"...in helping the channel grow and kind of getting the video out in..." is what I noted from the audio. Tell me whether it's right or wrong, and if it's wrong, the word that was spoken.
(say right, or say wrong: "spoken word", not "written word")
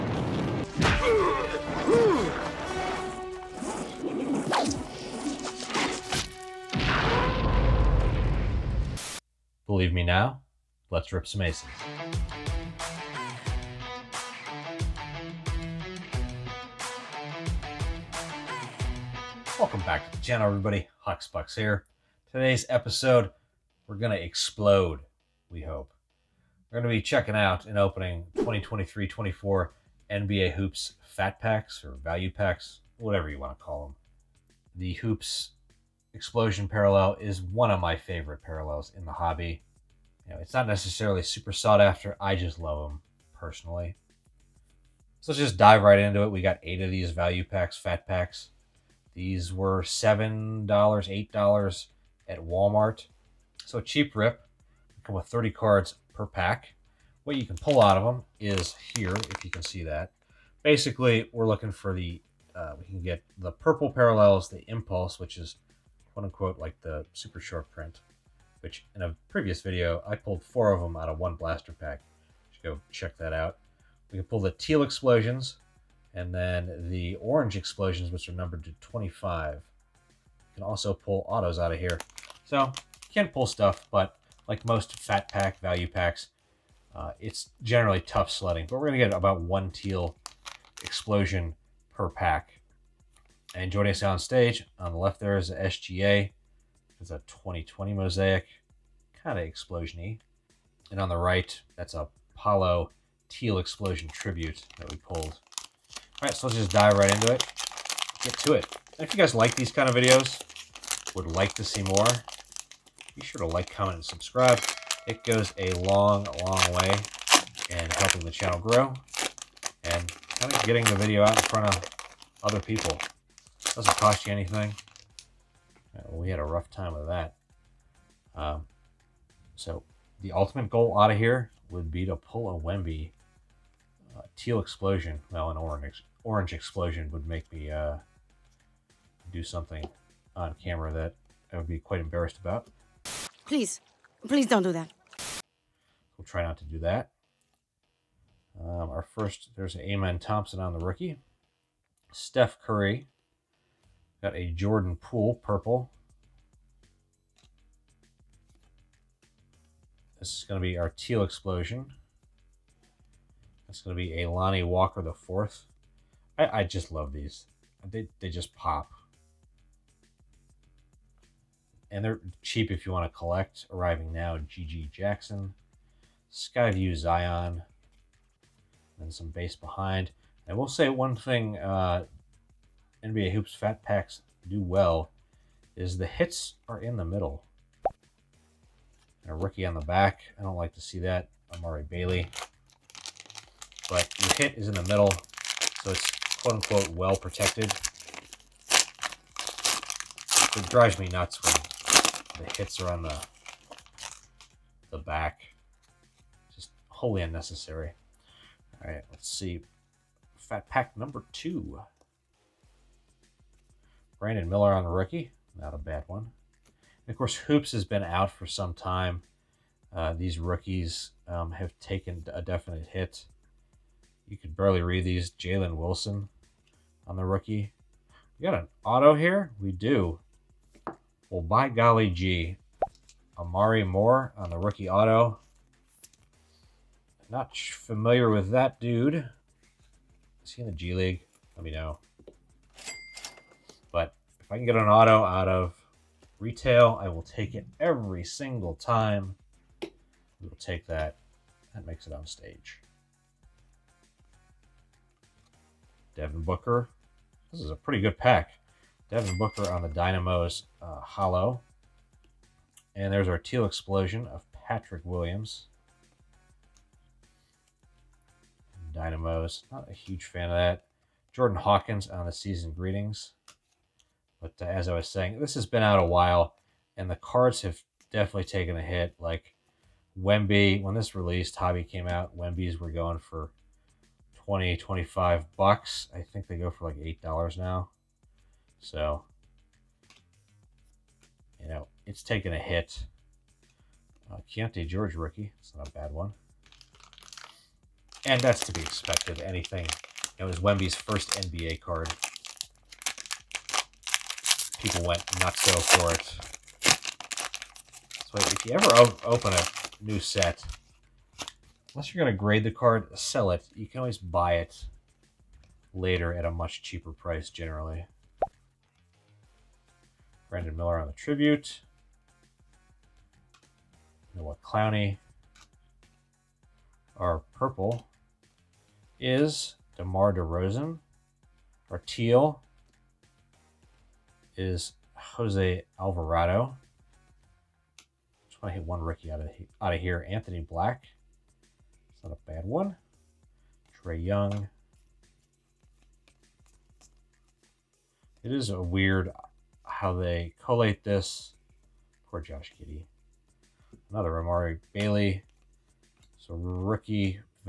right.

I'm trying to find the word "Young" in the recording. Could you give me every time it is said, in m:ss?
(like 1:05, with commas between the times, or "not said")
5:44.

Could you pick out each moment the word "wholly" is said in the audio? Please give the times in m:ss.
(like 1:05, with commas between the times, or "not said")
3:26.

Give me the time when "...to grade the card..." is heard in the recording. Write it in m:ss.
5:12.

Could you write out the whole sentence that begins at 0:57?
What you can pull out of them is here, if you can see that.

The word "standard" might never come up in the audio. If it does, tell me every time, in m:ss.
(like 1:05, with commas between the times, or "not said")
not said.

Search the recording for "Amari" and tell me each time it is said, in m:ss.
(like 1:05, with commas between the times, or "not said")
3:11, 3:53, 5:54.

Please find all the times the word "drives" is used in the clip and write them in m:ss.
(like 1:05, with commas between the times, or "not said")
3:20.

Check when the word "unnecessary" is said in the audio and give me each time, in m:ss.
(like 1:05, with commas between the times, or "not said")
3:27.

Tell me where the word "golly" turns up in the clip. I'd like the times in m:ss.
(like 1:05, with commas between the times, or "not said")
3:51.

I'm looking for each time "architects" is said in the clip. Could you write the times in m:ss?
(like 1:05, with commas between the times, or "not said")
not said.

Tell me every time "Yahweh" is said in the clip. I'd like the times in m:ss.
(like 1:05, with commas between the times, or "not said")
not said.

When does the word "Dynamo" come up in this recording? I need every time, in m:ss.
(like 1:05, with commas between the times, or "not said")
4:19, 4:28.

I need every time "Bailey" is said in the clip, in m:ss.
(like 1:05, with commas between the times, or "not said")
3:11, 5:54.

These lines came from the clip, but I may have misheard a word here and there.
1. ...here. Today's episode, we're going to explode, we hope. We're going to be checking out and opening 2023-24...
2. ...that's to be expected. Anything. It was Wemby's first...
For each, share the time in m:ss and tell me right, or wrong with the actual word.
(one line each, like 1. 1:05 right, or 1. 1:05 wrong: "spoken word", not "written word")
1. 0:21 right
2. 4:58 right.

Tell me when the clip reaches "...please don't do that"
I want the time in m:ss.
2:24.